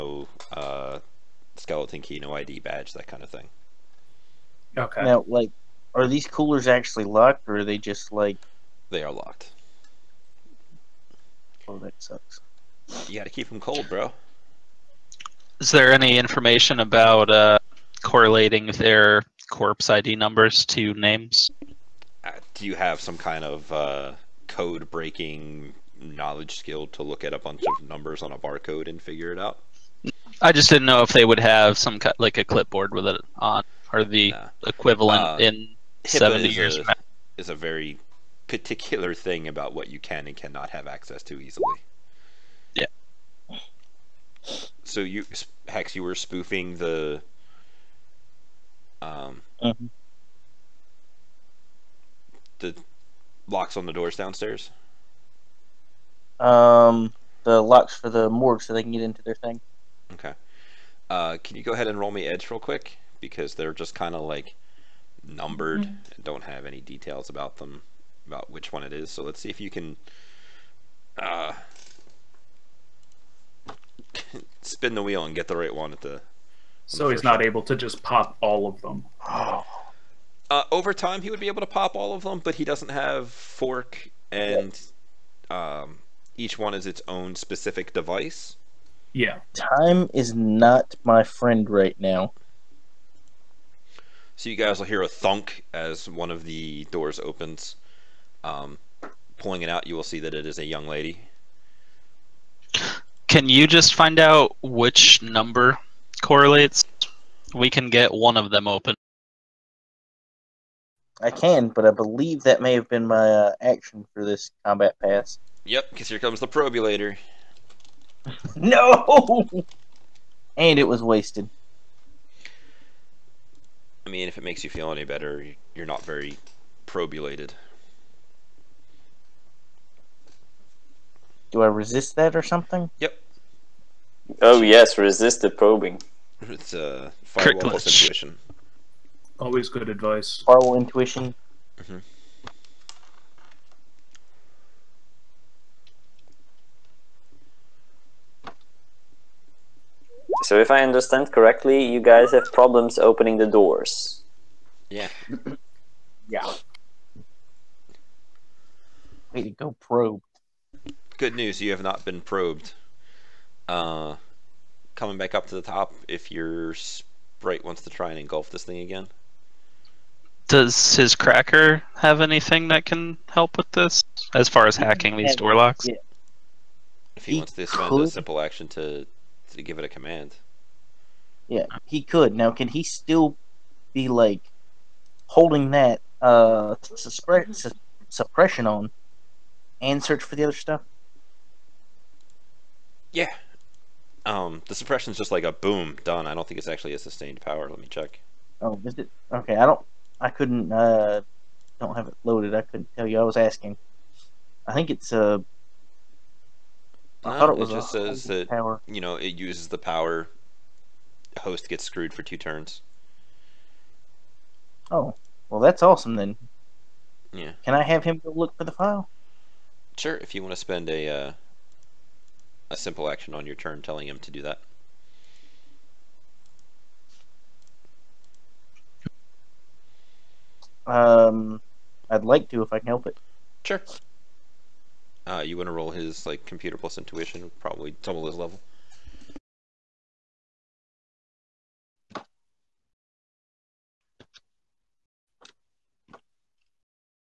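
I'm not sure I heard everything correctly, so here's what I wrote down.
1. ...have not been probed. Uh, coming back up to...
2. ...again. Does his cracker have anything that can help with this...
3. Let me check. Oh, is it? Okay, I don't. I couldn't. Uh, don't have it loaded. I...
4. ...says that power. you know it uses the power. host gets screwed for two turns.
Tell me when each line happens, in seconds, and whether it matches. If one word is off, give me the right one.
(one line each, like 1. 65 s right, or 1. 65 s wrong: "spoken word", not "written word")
1. 161 s right
2. 168 s right
3. 197 s right
4. 207 s right.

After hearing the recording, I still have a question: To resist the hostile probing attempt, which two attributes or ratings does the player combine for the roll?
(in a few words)
Firewall plus intuition.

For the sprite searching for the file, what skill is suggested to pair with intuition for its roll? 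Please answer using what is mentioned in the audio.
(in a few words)
Computer.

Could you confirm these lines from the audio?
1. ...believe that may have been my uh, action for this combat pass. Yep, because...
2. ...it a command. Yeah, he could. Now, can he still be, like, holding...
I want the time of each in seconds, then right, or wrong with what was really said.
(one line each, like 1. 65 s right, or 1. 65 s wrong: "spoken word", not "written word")
1. 111 s right
2. 179 s right.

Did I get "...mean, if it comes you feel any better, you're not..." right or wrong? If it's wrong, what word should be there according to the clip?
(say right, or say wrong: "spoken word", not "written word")
wrong: "makes", not "comes".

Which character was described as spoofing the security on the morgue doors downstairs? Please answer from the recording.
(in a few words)
Hex.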